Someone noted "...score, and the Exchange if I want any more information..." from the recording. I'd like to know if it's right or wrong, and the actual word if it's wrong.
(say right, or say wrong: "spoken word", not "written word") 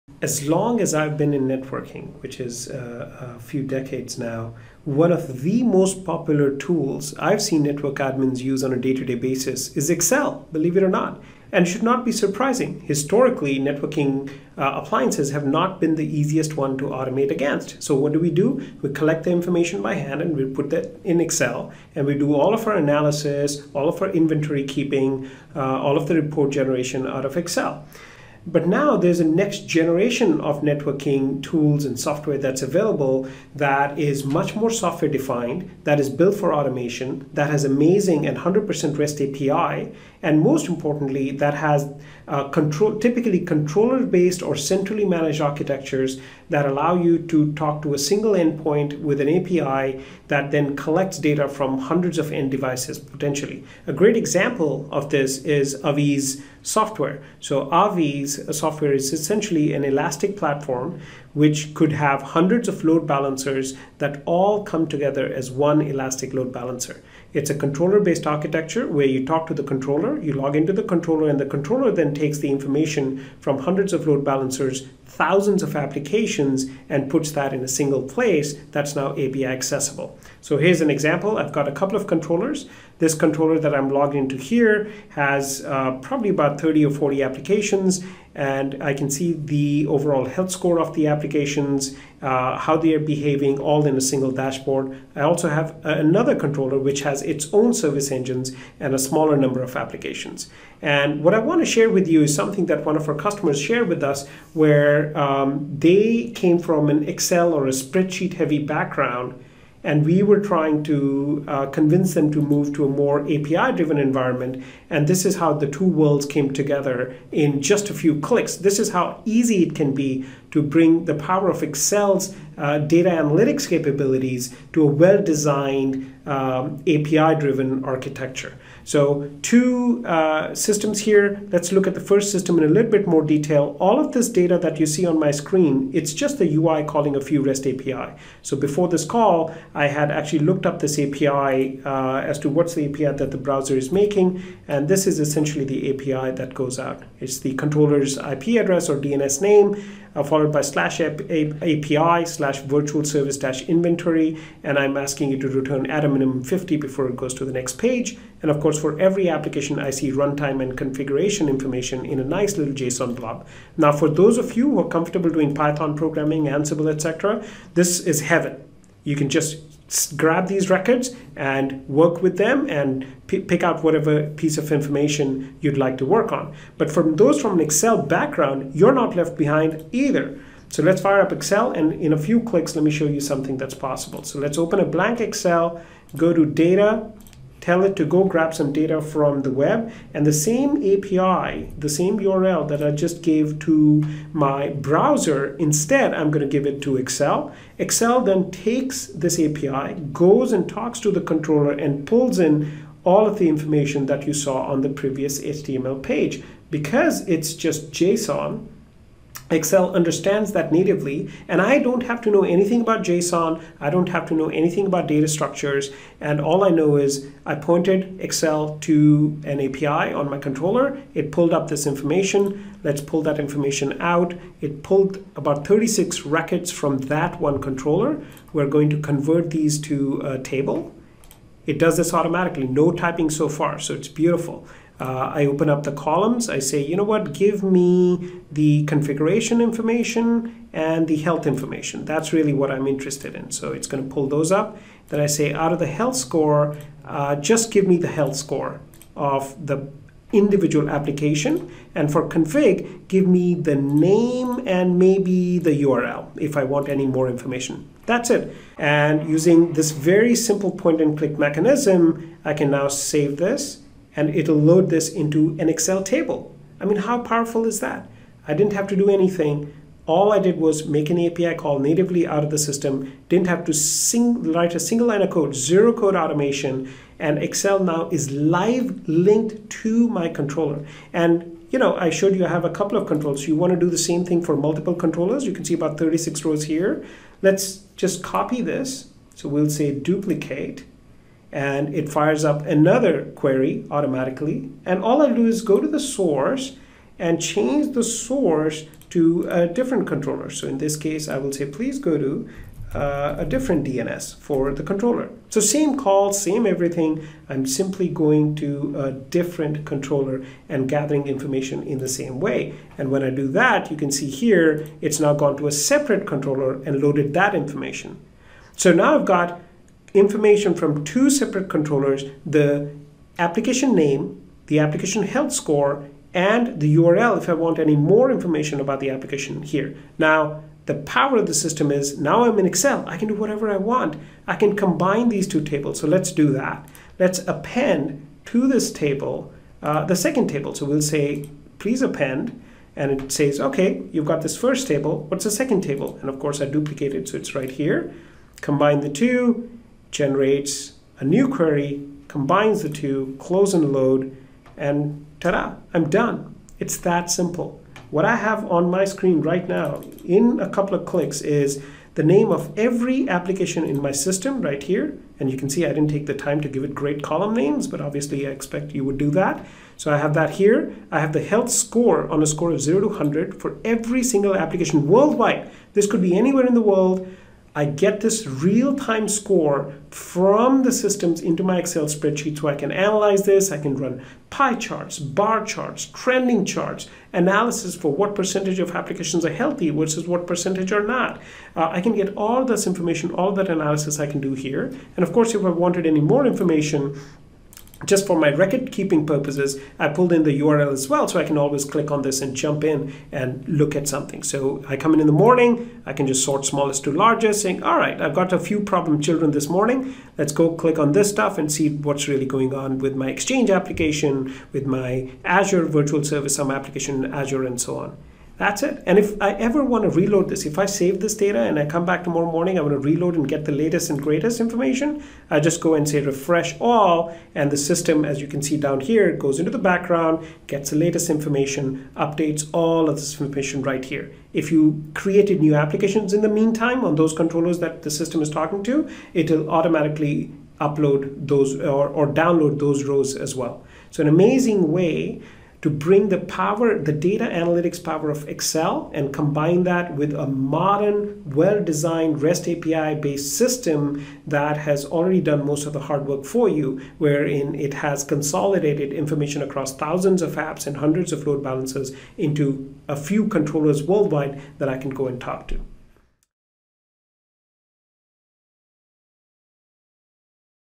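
wrong: "URL", not "Exchange".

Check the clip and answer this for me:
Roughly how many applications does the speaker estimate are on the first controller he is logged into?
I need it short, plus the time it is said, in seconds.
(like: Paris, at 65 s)
30 or 40, at 86 s.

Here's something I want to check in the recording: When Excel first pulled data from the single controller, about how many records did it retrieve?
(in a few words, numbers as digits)
36.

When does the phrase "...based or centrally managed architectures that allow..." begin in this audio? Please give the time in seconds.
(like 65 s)
44 s.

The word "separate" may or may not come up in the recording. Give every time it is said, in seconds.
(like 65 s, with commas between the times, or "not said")
315 s, 321 s.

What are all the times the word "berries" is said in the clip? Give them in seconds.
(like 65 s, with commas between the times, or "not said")
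not said.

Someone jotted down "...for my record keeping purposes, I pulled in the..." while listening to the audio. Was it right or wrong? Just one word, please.
right.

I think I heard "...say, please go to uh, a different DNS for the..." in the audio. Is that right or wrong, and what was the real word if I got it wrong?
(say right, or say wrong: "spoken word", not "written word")
right.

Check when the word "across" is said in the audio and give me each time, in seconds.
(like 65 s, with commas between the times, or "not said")
459 s.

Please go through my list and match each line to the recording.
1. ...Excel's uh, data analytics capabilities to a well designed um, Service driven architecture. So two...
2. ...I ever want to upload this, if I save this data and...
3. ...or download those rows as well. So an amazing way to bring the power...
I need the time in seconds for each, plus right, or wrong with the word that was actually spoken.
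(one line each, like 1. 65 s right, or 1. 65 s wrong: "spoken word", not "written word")
1. 121 s wrong: "API", not "Service"
2. 419 s wrong: "reload", not "upload"
3. 442 s right.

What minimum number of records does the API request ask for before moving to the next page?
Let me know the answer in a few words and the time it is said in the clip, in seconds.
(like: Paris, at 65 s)
50, at 156 s.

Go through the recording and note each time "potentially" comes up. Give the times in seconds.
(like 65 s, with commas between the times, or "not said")
52 s.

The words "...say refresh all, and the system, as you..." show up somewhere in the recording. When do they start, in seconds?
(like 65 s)
426 s.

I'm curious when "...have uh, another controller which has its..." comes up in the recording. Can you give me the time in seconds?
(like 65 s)
95 s.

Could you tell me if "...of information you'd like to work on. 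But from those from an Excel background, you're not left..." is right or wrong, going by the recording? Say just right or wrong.
right.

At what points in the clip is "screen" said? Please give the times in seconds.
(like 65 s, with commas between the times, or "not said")
135 s, 359 s.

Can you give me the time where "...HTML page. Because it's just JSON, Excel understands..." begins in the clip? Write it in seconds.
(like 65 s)
205 s.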